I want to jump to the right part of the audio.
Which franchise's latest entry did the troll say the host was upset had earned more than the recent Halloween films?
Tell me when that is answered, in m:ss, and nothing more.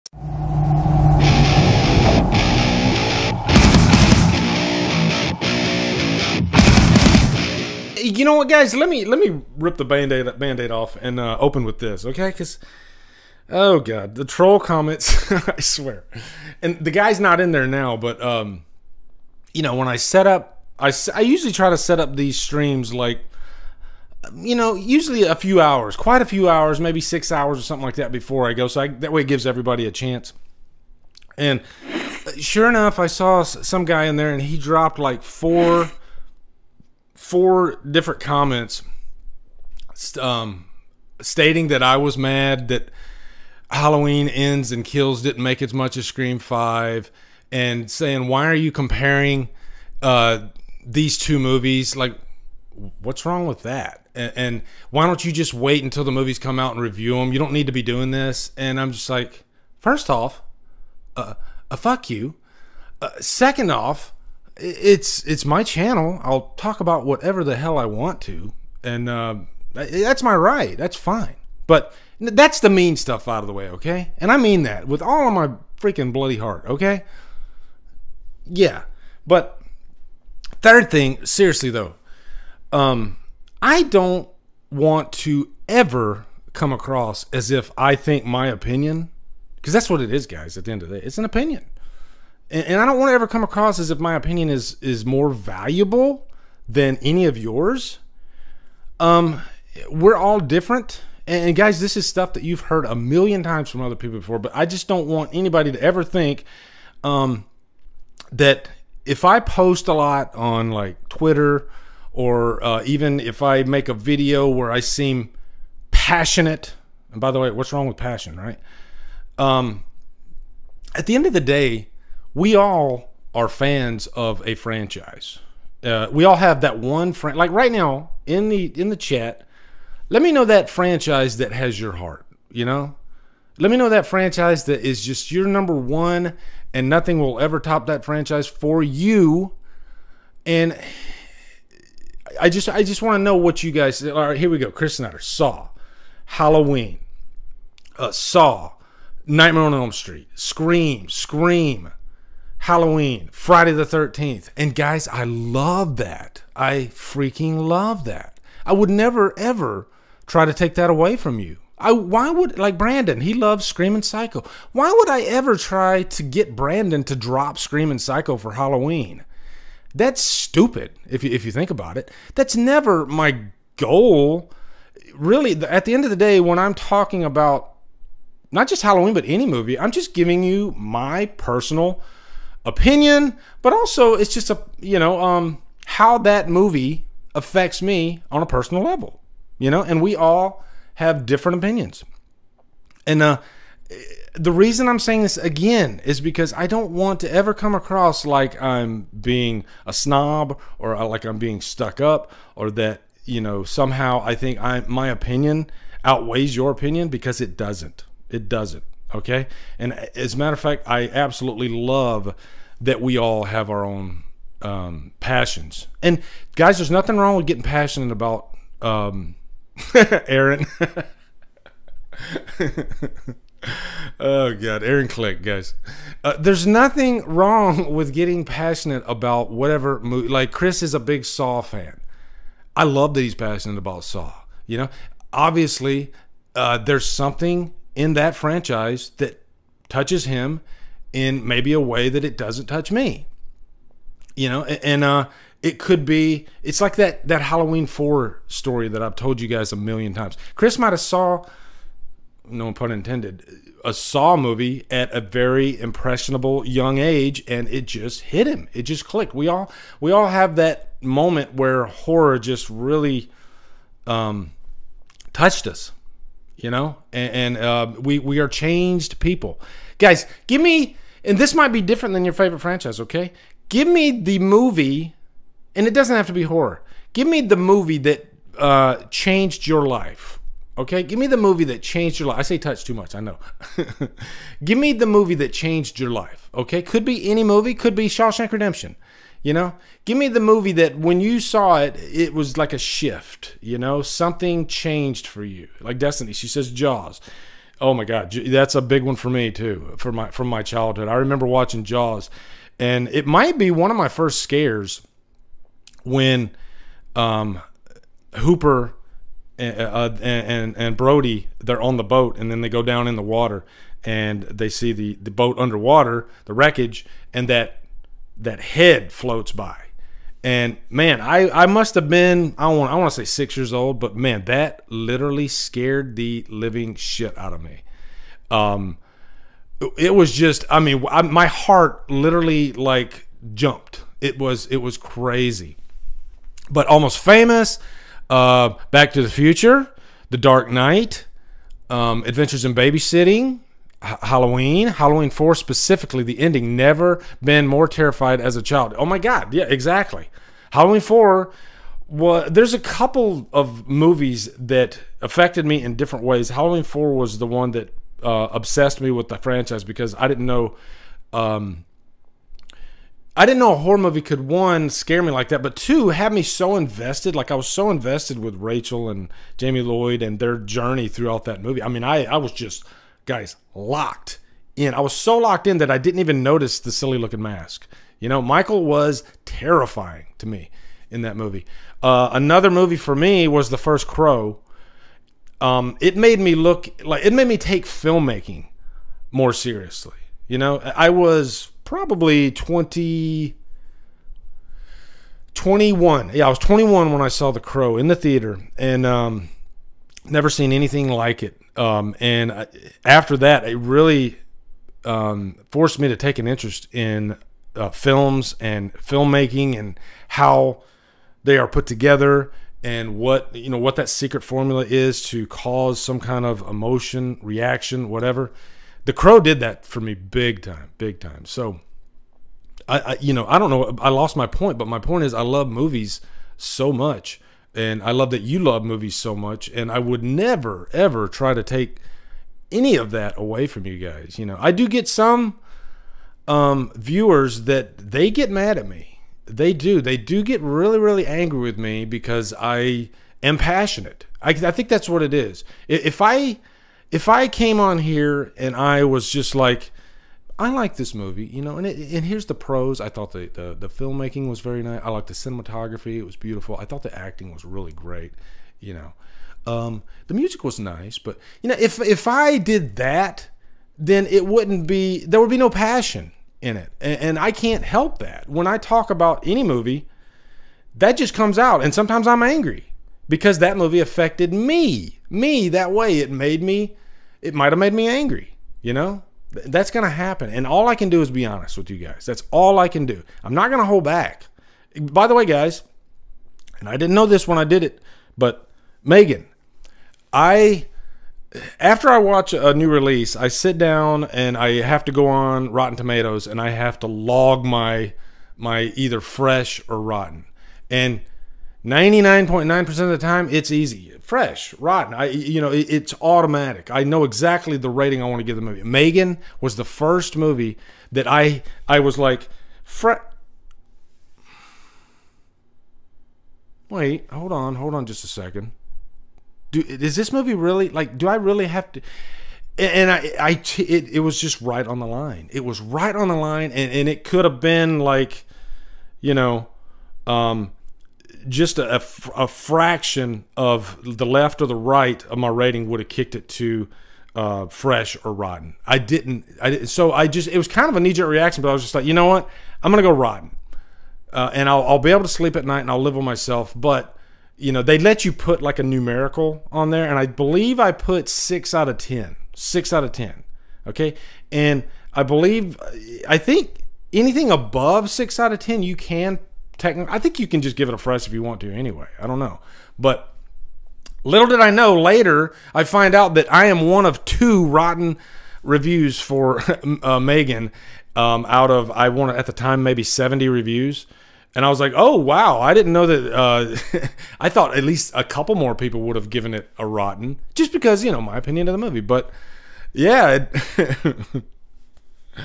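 0:46.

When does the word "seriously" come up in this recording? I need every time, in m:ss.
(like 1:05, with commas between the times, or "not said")
1:21, 6:29.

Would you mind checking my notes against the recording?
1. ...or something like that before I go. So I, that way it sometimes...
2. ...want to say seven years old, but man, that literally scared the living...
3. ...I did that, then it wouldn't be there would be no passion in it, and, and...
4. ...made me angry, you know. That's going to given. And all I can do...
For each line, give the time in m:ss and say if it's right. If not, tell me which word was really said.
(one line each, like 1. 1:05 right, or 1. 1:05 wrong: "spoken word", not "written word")
1. 0:27 wrong: "gives", not "sometimes"
2. 5:22 wrong: "six", not "seven"
3. 7:42 right
4. 7:57 wrong: "happen", not "given".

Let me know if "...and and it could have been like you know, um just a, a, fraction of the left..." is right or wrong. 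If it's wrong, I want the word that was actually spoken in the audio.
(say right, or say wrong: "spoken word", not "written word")
right.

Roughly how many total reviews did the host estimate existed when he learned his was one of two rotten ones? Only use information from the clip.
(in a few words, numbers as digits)
70.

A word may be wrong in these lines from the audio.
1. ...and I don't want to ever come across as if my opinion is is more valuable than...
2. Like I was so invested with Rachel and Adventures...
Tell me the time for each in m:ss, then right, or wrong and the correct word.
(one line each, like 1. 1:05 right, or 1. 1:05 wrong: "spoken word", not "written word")
1. 1:32 right
2. 6:07 wrong: "Jamie", not "Adventures".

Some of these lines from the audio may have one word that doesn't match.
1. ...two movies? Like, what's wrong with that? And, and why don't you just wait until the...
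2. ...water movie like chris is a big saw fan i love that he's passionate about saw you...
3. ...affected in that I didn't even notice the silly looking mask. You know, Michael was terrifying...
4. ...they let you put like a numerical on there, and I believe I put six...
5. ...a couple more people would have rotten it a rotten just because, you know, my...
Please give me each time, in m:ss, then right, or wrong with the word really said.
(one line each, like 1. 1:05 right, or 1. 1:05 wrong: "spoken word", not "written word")
1. 0:51 right
2. 3:49 wrong: "whatever", not "water"
3. 6:15 wrong: "locked", not "affected"
4. 9:07 right
5. 9:38 wrong: "given", not "rotten".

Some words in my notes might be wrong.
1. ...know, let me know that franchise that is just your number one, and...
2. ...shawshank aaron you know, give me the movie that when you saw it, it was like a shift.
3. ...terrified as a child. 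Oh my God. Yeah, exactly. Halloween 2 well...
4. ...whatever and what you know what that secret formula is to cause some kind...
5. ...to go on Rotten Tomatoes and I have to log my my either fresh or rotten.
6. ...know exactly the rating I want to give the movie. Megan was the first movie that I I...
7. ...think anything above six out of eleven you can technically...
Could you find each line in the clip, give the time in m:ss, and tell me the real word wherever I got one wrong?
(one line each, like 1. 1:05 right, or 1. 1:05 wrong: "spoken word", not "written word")
1. 2:12 right
2. 4:48 wrong: "redemption", not "aaron"
3. 5:47 wrong: "4", not "2"
4. 6:51 wrong: "together", not "whatever"
5. 8:15 right
6. 8:27 right
7. 9:16 wrong: "ten", not "eleven".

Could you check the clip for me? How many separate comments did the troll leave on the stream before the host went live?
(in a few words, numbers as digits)
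4.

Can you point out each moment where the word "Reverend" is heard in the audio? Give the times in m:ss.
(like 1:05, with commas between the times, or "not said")
not said.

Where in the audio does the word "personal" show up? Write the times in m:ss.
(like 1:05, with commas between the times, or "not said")
3:01, 3:08.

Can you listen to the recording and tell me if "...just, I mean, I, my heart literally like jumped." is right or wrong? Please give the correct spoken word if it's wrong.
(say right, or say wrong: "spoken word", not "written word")
right.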